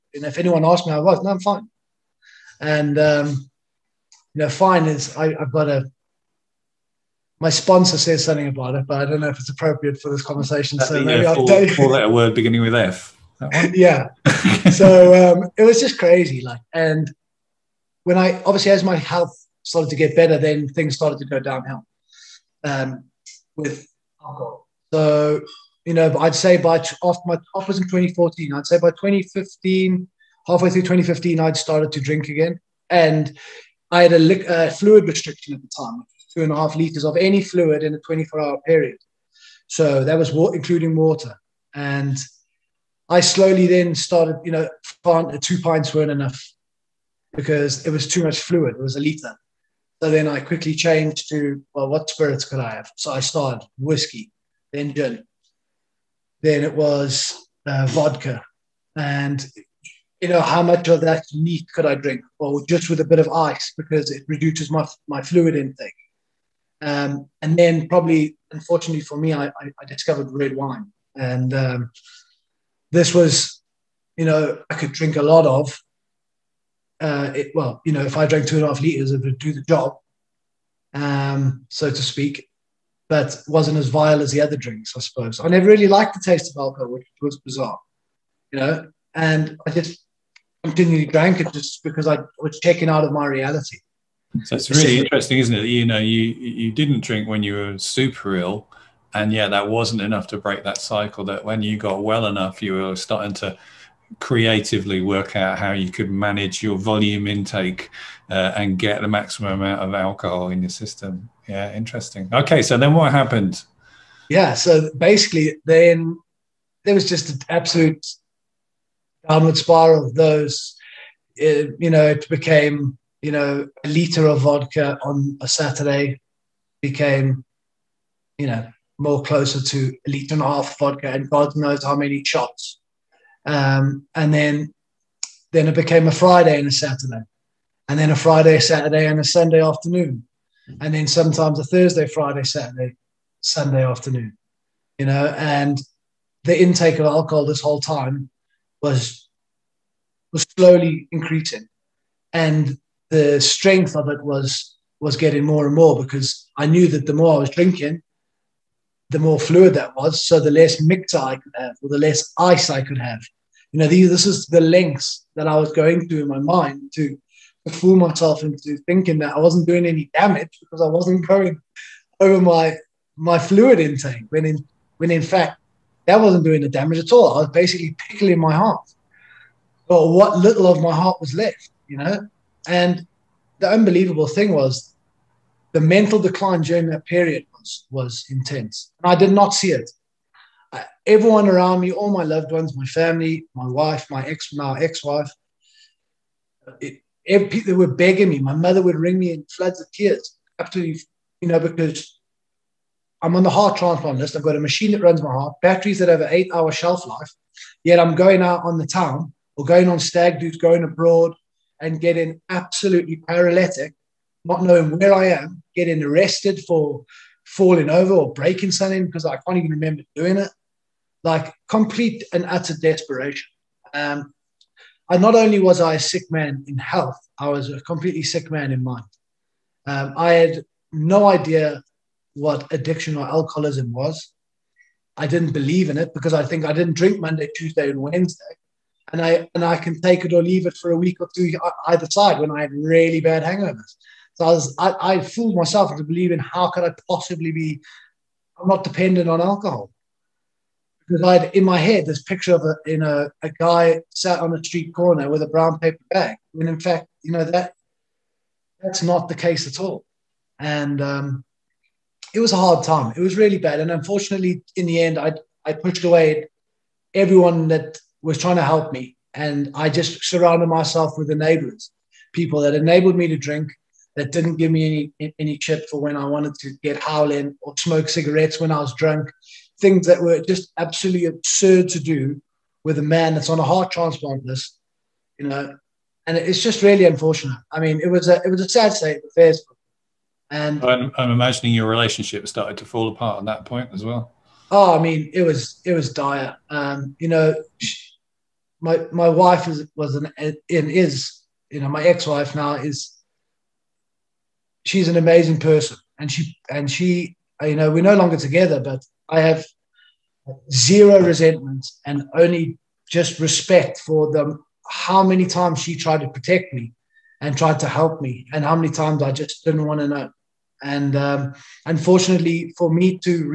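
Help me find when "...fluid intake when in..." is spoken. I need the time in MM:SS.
02:53.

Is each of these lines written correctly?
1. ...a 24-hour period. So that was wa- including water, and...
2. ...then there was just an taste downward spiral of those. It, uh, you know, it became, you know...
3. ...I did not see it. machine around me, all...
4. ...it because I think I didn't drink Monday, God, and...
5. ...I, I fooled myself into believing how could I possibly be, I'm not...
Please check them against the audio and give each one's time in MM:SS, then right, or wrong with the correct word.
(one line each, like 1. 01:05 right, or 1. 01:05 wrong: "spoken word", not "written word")
1. 00:37 right
2. 01:55 wrong: "absolute", not "taste"
3. 03:09 wrong: "everyone", not "machine"
4. 03:55 wrong: "Tuesday", not "God"
5. 04:04 right.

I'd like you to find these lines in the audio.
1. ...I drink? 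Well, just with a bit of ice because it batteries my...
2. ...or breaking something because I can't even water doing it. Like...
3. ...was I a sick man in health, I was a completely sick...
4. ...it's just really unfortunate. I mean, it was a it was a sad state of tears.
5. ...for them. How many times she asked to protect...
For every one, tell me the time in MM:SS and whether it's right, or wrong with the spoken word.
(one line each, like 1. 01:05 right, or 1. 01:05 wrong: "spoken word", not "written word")
1. 01:01 wrong: "reduces", not "batteries"
2. 03:38 wrong: "remember", not "water"
3. 03:45 right
4. 04:46 wrong: "affairs", not "tears"
5. 05:13 wrong: "tried", not "asked".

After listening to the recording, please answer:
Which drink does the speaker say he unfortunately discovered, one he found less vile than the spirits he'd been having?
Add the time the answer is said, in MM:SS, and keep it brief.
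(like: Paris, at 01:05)
red wine, at 01:10.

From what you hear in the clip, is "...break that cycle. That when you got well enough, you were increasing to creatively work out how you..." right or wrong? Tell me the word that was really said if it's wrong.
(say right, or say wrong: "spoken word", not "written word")
wrong: "starting", not "increasing".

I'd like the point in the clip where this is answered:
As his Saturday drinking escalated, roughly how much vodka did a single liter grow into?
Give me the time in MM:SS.
02:10.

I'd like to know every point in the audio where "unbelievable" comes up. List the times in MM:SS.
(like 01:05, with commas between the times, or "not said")
03:03.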